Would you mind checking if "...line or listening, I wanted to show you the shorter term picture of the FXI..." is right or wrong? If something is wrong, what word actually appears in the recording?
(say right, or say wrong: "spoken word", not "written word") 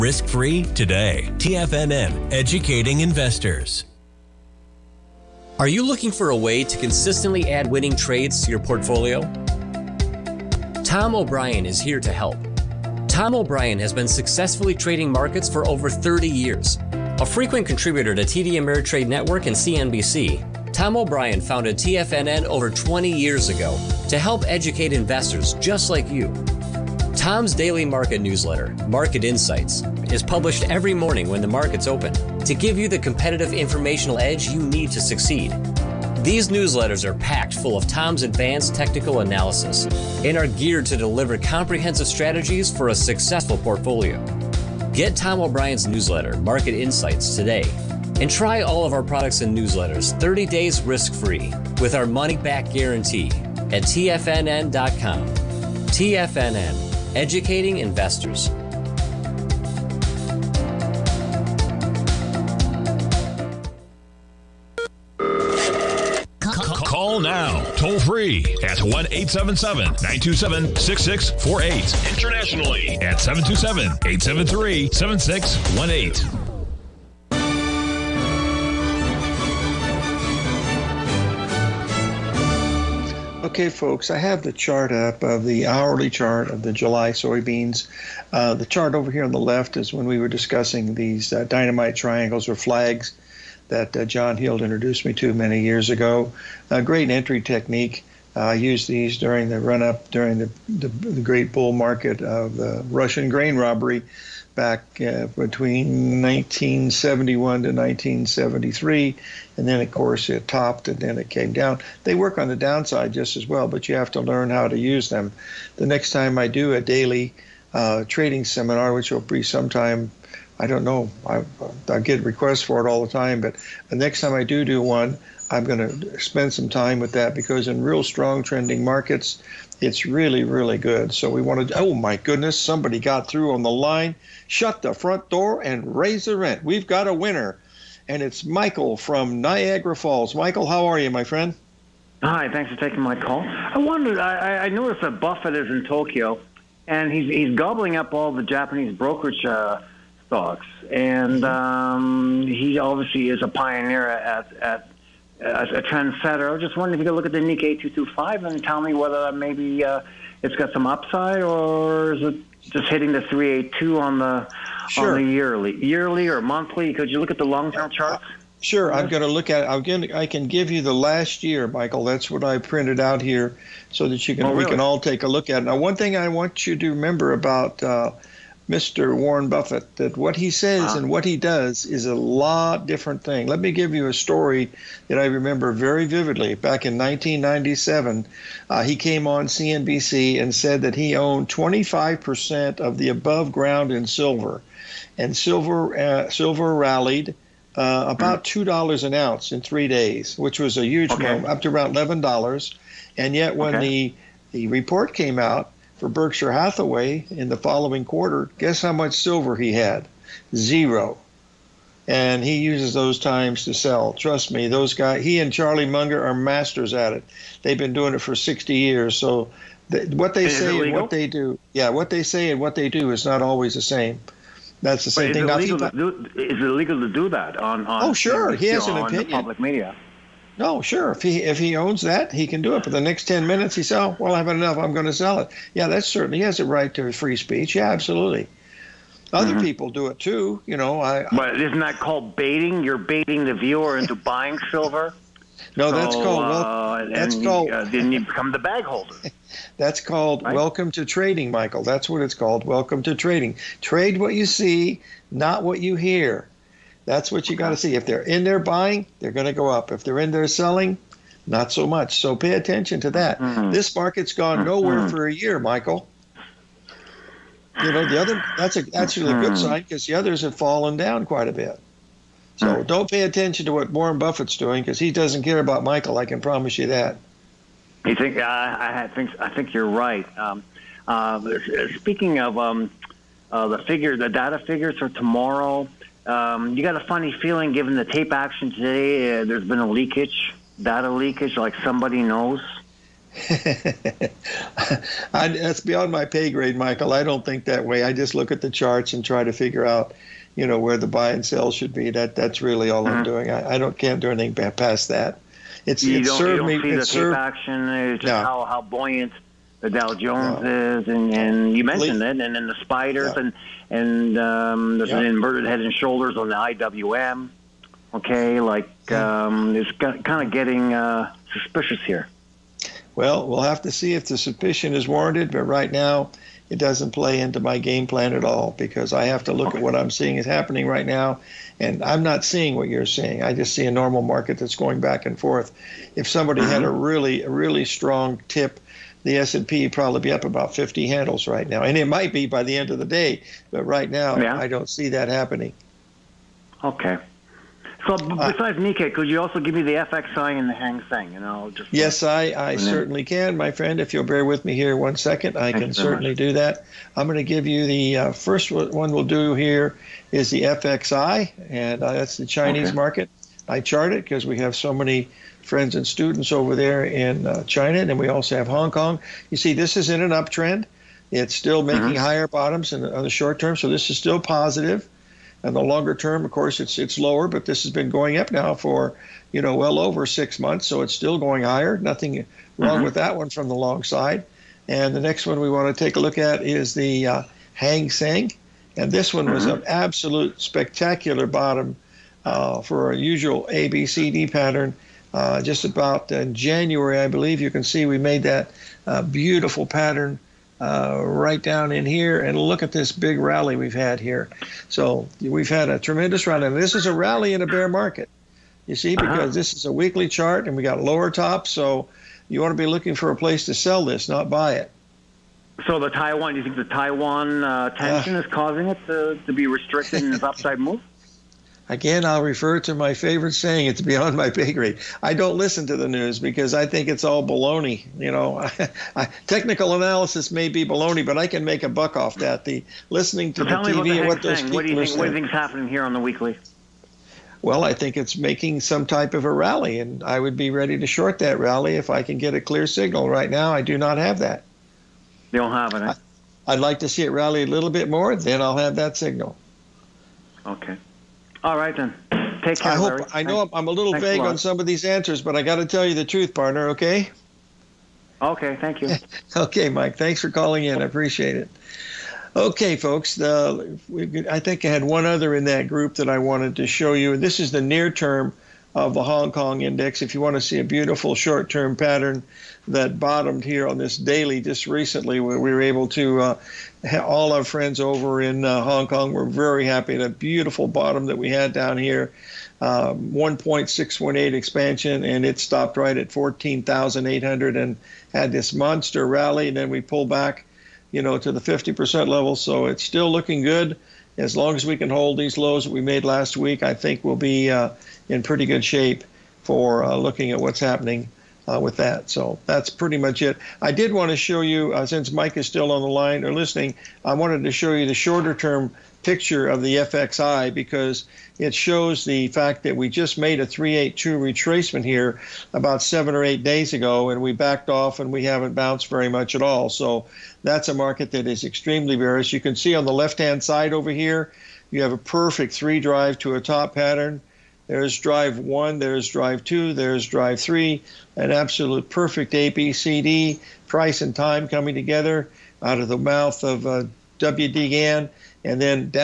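right.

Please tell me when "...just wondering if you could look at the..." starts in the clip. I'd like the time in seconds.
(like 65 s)
156 s.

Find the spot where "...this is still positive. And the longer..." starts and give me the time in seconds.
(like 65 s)
373 s.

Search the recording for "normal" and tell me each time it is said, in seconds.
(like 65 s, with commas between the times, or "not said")
333 s.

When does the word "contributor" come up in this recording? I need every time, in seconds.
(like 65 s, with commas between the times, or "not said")
17 s.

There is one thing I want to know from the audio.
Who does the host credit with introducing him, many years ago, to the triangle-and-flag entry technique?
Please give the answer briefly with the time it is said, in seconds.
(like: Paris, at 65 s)
John Heald, at 94 s.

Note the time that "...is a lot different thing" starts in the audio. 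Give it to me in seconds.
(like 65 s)
181 s.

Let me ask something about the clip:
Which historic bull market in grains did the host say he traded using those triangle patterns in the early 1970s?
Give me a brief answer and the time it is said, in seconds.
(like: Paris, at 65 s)
Russian grain robbery, at 102 s.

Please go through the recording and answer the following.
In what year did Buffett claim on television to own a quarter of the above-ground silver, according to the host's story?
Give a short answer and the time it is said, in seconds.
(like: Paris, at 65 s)
1997, at 186 s.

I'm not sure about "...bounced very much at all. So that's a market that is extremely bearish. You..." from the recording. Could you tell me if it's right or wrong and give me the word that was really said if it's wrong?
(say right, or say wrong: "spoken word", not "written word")
right.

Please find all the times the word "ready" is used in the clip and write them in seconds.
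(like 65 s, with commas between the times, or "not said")
440 s.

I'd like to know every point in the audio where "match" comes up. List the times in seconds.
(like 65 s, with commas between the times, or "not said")
not said.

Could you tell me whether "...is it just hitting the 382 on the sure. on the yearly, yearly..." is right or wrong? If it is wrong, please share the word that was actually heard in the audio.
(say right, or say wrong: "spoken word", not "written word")
right.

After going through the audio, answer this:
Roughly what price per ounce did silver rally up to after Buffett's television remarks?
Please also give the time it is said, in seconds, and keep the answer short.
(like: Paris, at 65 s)
$11, at 201 s.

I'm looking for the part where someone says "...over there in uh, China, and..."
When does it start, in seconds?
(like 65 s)
366 s.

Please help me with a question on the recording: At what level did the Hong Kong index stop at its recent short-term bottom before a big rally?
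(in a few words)
14,800.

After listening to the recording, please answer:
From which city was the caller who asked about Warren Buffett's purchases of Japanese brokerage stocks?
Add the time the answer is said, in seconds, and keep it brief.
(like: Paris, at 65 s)
Niagara Falls, at 139 s.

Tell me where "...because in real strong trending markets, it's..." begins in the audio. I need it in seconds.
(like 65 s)
127 s.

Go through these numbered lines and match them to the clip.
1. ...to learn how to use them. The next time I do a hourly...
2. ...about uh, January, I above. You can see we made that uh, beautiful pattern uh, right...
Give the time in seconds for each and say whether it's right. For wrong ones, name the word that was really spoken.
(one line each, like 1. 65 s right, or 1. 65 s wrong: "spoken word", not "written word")
1. 114 s wrong: "daily", not "hourly"
2. 395 s wrong: "believe", not "above".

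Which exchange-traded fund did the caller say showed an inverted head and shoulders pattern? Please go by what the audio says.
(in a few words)
IWM.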